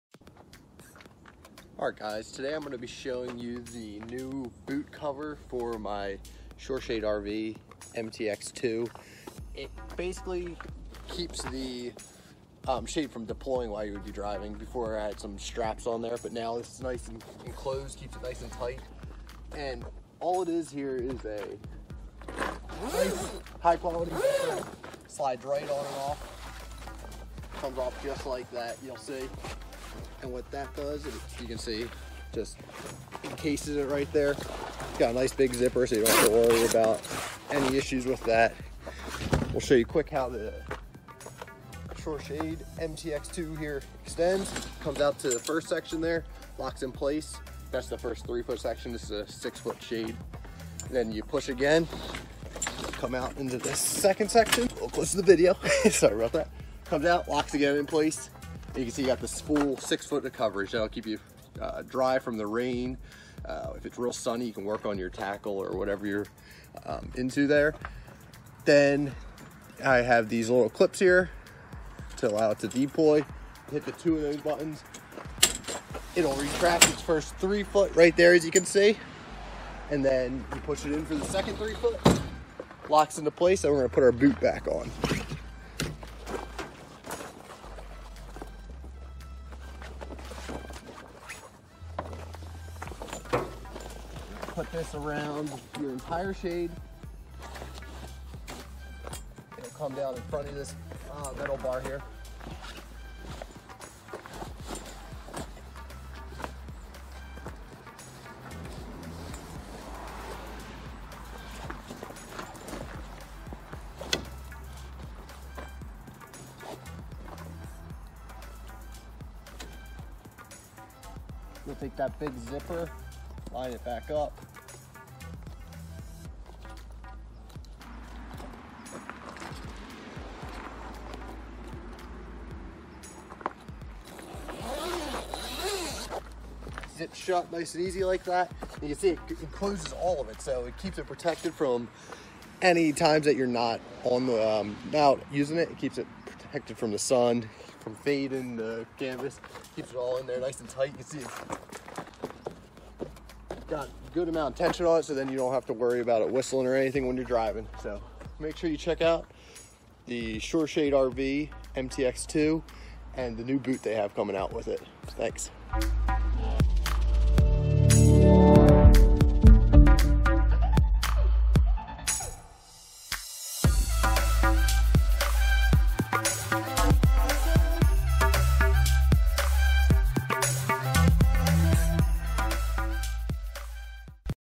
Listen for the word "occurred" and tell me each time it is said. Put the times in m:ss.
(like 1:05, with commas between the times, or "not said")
not said.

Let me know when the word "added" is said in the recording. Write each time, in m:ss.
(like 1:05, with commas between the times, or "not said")
not said.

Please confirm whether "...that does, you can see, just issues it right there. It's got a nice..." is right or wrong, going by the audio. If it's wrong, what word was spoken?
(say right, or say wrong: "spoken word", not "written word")
wrong: "encases", not "issues".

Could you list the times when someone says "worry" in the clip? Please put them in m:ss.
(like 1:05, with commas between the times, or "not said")
0:36, 2:35.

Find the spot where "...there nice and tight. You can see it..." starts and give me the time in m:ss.
2:30.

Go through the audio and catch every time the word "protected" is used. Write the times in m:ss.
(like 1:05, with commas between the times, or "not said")
2:21, 2:26.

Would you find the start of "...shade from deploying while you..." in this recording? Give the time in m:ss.
0:12.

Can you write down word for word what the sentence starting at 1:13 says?
Hit the two of those buttons.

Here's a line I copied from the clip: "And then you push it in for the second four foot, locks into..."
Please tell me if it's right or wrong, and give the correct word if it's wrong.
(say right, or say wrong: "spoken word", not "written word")
wrong: "three", not "four".